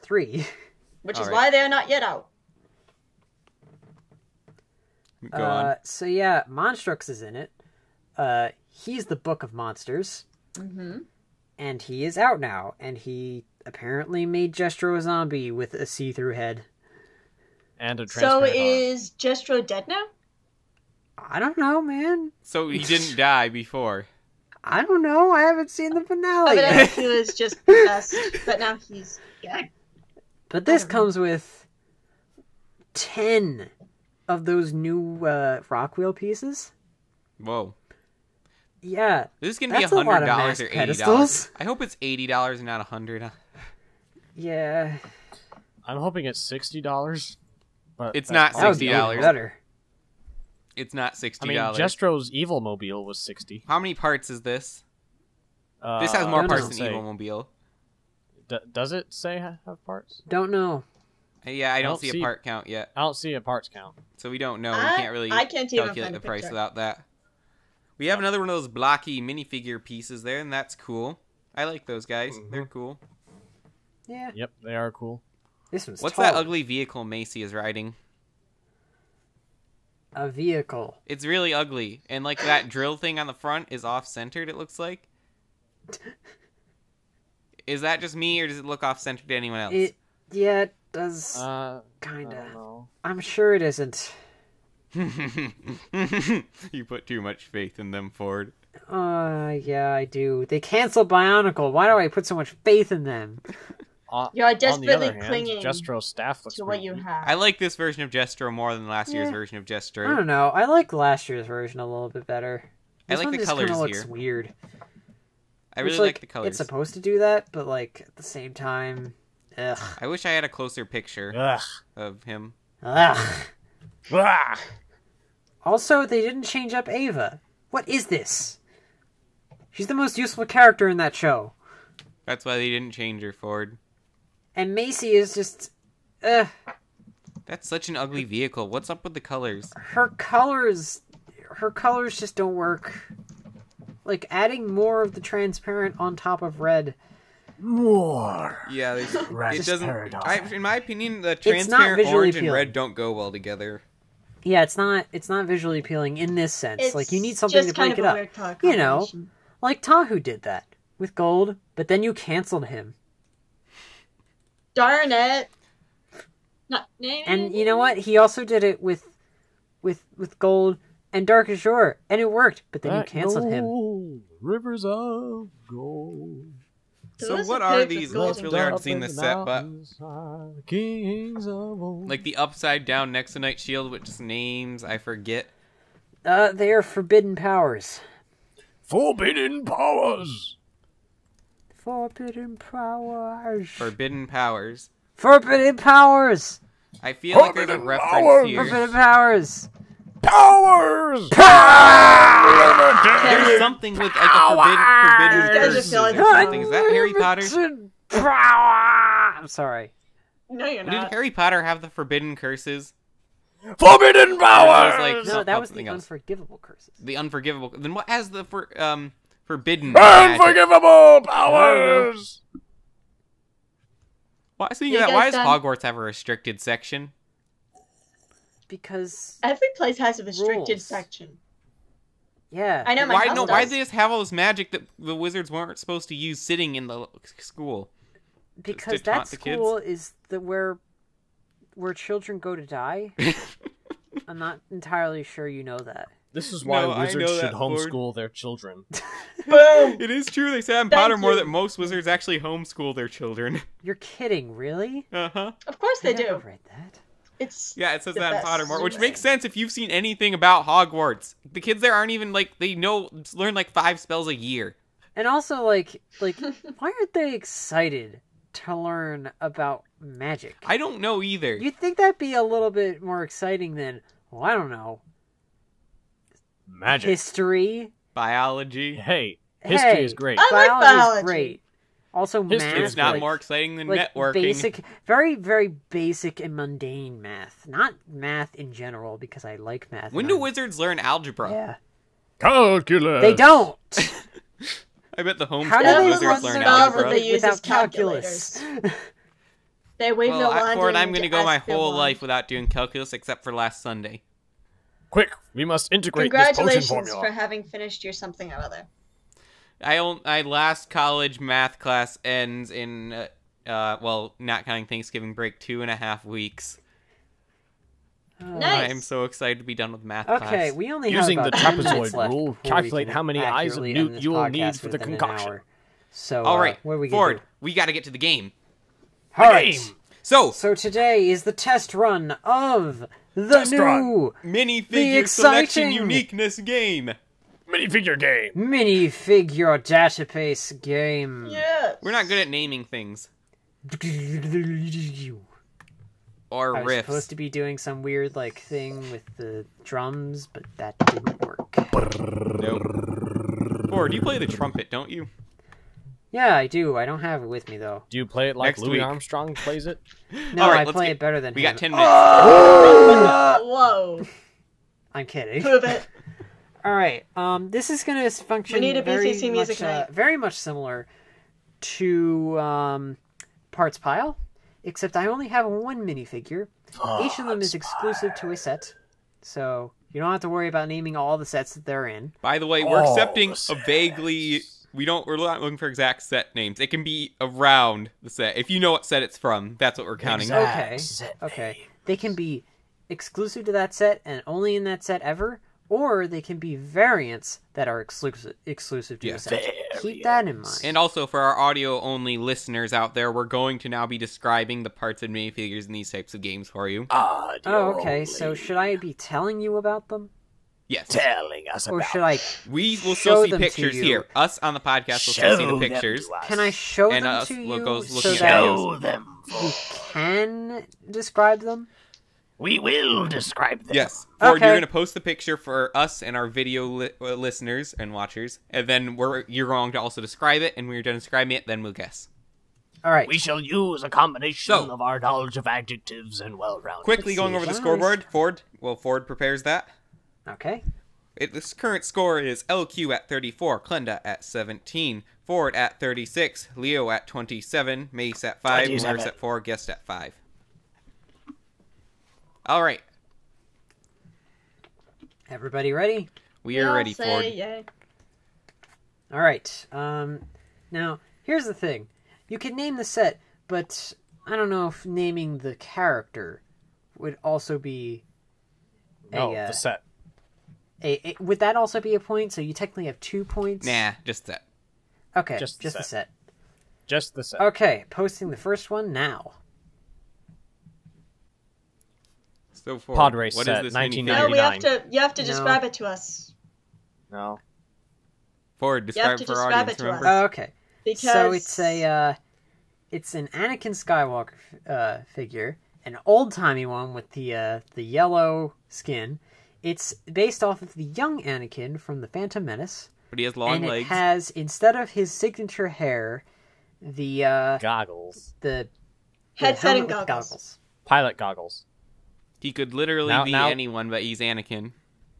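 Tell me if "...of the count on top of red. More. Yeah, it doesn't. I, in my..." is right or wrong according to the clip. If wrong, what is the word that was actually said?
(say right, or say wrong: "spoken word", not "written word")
wrong: "transparent", not "count".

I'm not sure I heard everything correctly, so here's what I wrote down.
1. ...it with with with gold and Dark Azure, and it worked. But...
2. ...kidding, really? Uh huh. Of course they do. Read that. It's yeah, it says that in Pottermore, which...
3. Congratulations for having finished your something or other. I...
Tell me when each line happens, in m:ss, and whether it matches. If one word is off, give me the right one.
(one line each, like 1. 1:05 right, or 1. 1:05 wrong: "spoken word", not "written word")
1. 2:48 right
2. 4:13 right
3. 5:06 right.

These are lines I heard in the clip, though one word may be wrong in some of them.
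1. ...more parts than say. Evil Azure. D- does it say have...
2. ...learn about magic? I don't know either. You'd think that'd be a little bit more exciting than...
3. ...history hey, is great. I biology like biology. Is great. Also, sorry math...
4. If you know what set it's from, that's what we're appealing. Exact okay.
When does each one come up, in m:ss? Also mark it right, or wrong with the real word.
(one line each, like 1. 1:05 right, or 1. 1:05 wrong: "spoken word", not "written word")
1. 0:56 wrong: "Mobile", not "Azure"
2. 4:28 right
3. 4:39 wrong: "history", not "sorry"
4. 6:28 wrong: "counting", not "appealing".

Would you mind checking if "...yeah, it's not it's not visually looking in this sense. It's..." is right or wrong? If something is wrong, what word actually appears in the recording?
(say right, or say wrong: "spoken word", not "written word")
wrong: "appealing", not "looking".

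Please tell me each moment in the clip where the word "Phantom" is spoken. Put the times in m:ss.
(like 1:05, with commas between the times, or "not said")
8:22.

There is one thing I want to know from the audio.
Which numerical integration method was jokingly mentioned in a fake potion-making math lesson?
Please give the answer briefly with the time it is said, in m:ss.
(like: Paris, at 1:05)
the trapezoid rule, at 5:21.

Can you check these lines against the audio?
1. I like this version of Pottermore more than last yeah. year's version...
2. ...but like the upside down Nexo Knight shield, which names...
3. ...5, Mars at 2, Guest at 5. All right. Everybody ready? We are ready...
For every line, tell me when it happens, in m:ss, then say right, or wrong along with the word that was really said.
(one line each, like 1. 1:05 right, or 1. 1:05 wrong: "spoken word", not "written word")
1. 1:47 wrong: "Jestro", not "Pottermore"
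2. 2:59 right
3. 7:28 wrong: "4", not "2".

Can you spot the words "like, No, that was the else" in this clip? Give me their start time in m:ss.
3:35.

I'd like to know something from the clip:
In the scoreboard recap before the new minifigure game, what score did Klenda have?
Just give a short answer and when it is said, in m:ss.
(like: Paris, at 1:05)
17, at 7:24.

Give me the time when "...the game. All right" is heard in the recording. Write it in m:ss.
5:28.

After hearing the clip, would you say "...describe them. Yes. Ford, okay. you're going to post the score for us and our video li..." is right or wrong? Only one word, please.
wrong.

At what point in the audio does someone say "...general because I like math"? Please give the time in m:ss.
4:48.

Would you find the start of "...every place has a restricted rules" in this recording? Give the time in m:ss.
3:49.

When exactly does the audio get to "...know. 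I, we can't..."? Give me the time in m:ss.
1:04.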